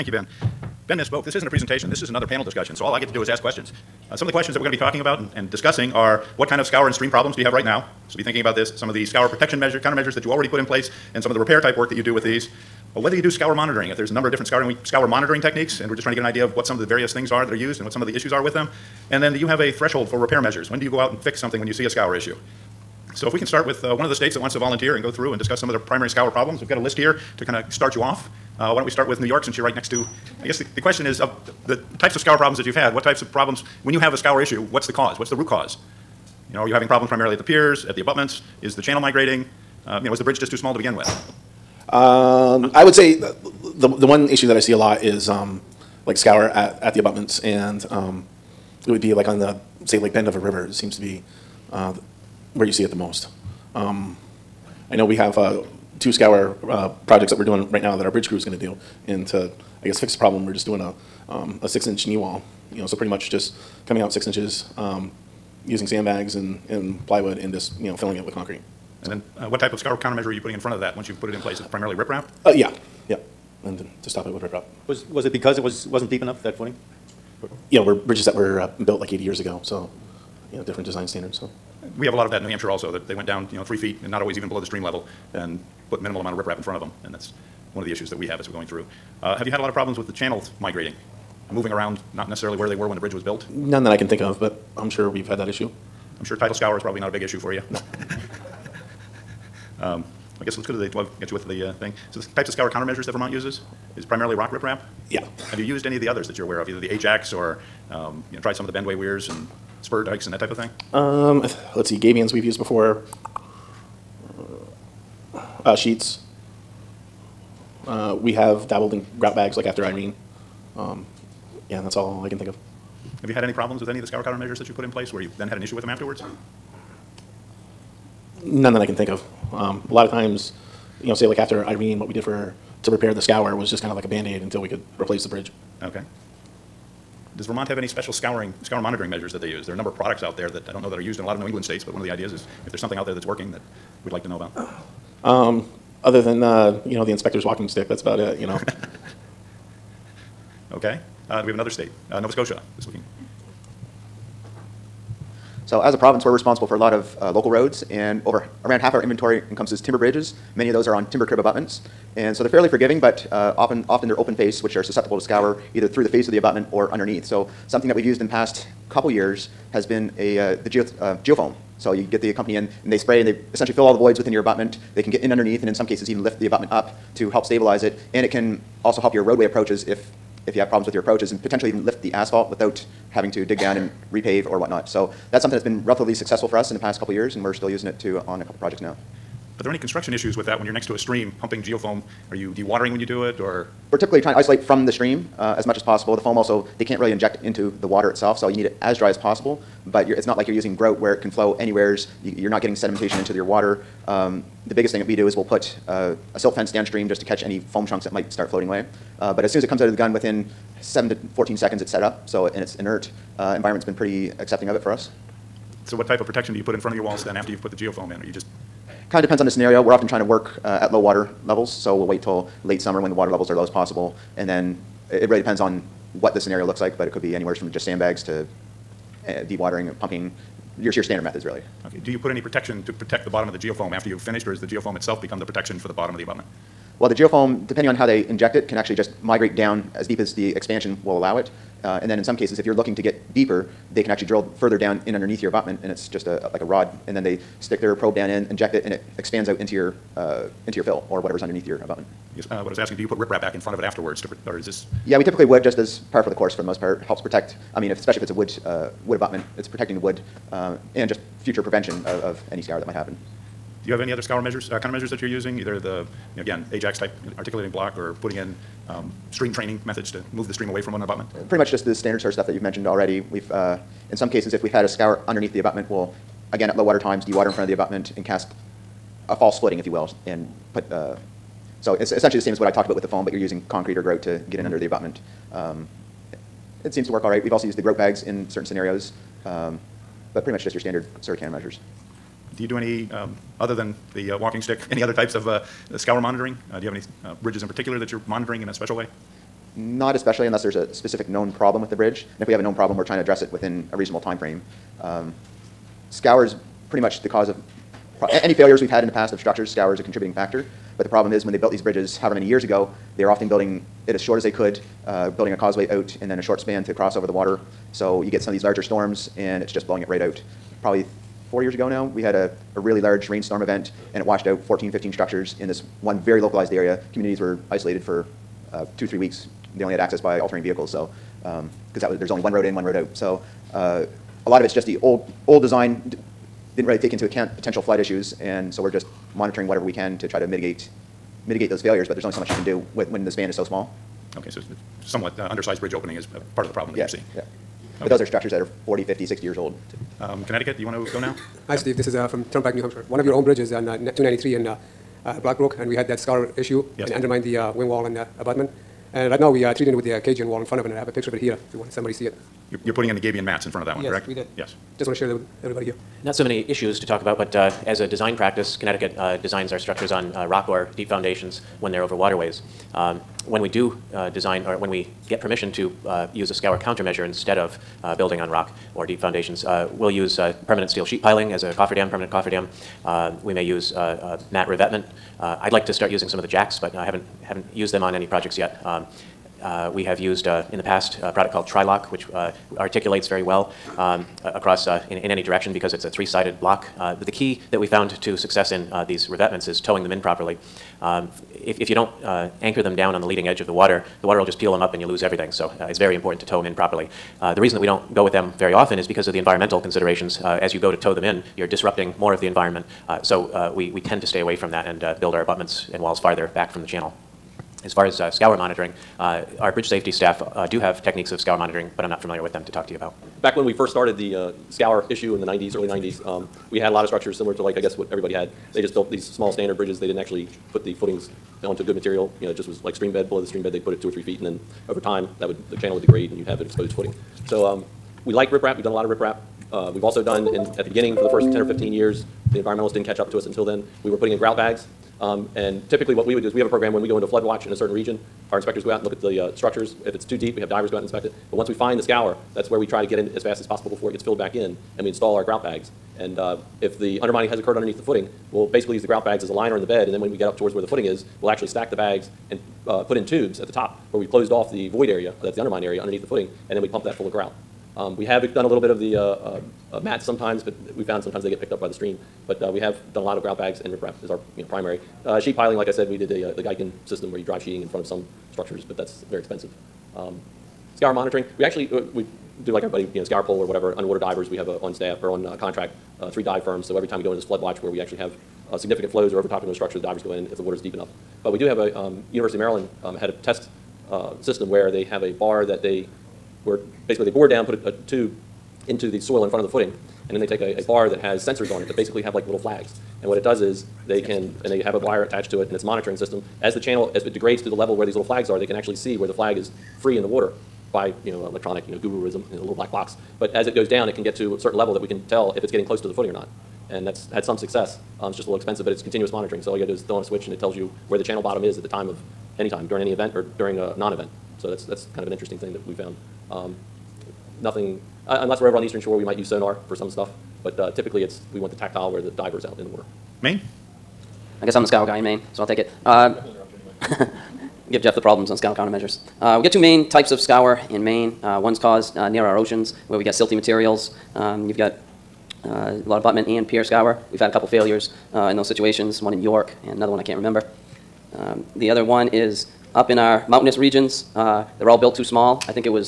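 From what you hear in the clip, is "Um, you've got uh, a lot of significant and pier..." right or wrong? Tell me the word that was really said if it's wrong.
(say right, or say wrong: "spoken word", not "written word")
wrong: "buttment", not "significant".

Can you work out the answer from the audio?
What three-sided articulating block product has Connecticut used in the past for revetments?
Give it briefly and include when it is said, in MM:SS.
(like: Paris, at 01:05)
Trilock, at 06:31.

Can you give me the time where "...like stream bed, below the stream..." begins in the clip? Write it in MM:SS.
07:12.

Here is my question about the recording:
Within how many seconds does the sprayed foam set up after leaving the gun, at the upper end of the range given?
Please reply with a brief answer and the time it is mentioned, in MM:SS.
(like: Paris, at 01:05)
14 seconds, at 03:31.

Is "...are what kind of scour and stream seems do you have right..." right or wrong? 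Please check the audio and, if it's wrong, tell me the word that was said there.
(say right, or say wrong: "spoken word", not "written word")
wrong: "problems", not "seems".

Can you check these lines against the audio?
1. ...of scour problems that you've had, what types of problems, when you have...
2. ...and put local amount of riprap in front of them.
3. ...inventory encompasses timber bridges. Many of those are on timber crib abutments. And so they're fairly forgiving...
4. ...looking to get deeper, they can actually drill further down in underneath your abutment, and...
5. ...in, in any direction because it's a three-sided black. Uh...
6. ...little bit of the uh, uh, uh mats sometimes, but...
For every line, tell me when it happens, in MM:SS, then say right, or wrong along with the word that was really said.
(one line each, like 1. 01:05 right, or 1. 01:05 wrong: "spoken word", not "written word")
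1. 00:32 right
2. 01:25 wrong: "minimal", not "local"
3. 02:39 right
4. 04:02 right
5. 06:35 wrong: "block", not "black"
6. 07:48 right.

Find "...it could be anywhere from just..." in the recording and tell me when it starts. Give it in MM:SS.
03:47.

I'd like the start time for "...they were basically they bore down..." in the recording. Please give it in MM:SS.
08:15.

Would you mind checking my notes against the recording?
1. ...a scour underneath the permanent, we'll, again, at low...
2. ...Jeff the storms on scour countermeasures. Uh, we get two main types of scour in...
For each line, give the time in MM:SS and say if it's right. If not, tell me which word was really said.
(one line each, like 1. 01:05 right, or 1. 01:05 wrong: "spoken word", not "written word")
1. 04:34 wrong: "abutment", not "permanent"
2. 08:58 wrong: "problems", not "storms".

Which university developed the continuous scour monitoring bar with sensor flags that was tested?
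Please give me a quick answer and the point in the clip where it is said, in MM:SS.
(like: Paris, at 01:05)
University of Maryland, at 08:12.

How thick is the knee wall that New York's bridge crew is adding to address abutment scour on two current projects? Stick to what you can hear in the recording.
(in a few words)
6 inches.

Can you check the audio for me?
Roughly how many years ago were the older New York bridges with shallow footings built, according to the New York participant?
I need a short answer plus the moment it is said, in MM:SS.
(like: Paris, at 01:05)
80 years, at 01:19.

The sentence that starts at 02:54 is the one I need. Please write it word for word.
They can get in underneath and in some cases even lift the abutment up to help stabilize it.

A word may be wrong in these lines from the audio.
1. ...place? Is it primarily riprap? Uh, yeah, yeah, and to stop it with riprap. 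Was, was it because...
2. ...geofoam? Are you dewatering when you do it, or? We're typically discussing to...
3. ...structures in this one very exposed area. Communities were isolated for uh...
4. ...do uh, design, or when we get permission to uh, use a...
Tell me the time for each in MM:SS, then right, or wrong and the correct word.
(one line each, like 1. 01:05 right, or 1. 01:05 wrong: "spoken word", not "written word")
1. 01:11 right
2. 03:11 wrong: "trying", not "discussing"
3. 05:25 wrong: "localized", not "exposed"
4. 06:13 right.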